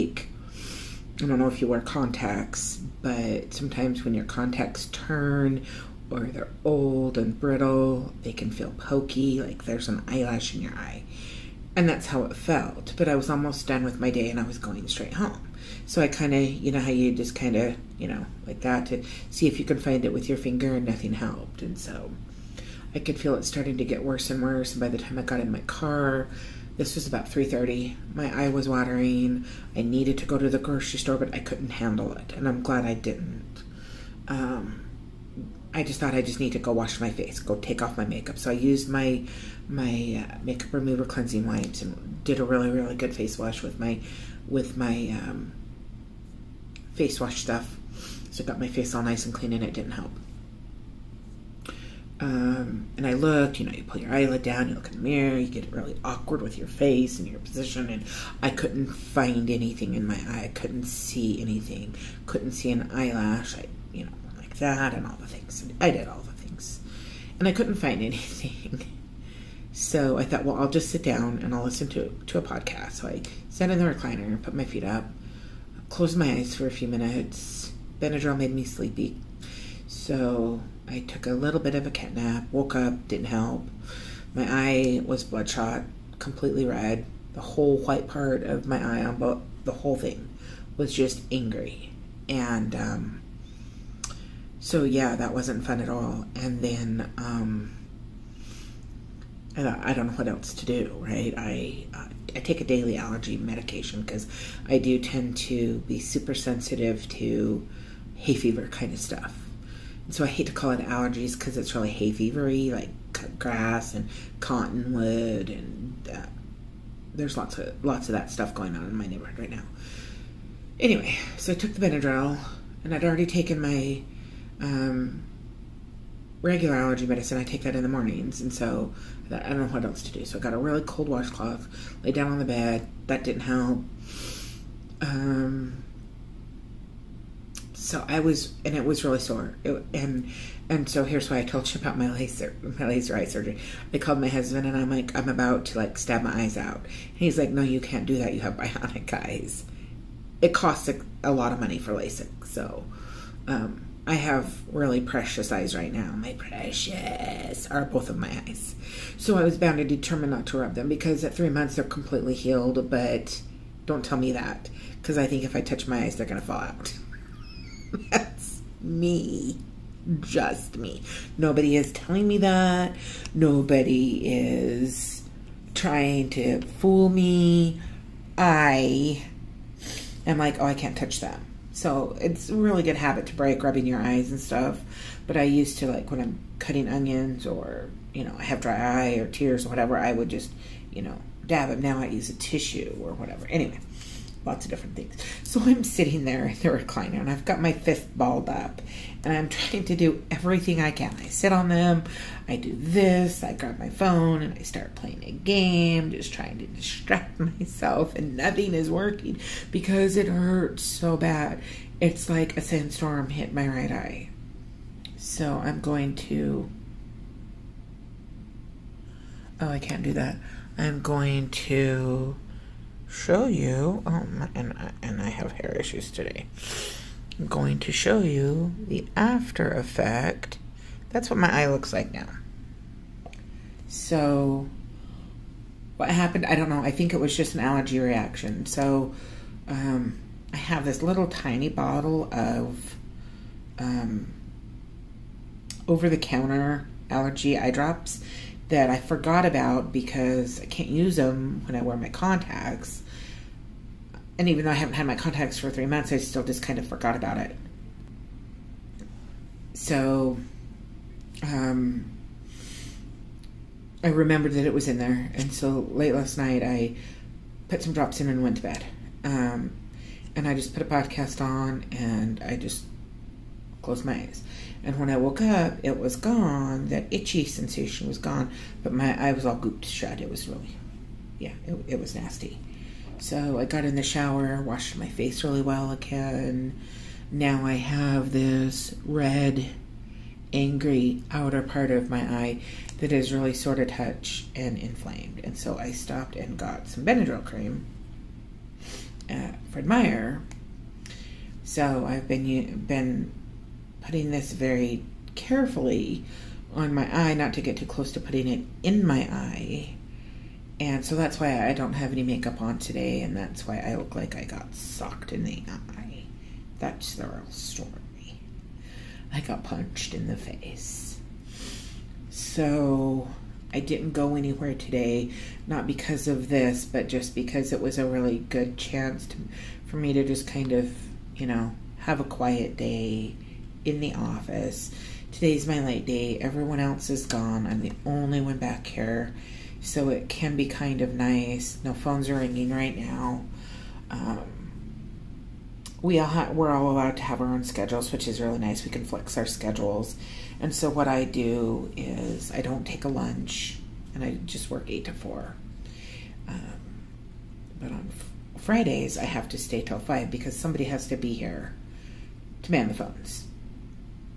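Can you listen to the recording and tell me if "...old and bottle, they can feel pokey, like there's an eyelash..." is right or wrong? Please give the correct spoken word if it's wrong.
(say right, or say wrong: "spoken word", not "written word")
wrong: "brittle", not "bottle".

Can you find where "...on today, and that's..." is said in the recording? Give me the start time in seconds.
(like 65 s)
312 s.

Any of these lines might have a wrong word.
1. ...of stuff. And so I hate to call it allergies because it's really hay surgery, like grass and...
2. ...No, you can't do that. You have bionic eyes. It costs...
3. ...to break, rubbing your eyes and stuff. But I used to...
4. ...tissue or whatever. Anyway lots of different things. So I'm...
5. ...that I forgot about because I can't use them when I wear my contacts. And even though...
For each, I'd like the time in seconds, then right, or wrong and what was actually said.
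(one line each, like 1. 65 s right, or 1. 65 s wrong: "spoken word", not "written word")
1. 108 s wrong: "fevery", not "surgery"
2. 147 s right
3. 183 s right
4. 192 s right
5. 248 s right.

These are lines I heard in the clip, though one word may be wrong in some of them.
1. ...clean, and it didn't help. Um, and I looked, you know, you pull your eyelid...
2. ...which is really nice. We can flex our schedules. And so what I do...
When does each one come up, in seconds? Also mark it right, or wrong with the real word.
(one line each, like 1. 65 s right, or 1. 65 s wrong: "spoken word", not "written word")
1. 49 s right
2. 348 s right.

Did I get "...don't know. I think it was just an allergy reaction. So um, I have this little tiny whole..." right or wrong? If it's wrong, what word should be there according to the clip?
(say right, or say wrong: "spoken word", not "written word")
wrong: "bottle", not "whole".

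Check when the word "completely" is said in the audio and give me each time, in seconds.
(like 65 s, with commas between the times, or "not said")
86 s, 161 s.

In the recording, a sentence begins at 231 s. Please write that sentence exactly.
That's what my eye looks like now.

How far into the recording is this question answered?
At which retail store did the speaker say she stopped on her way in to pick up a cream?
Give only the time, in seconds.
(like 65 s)
299 s.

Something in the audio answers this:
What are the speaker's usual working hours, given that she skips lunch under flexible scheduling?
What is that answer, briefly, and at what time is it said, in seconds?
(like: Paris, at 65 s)
8 to 4, at 354 s.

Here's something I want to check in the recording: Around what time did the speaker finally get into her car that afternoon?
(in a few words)
3:30.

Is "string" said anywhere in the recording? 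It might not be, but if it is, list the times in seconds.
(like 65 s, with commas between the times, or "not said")
not said.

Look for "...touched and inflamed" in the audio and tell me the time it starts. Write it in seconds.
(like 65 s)
293 s.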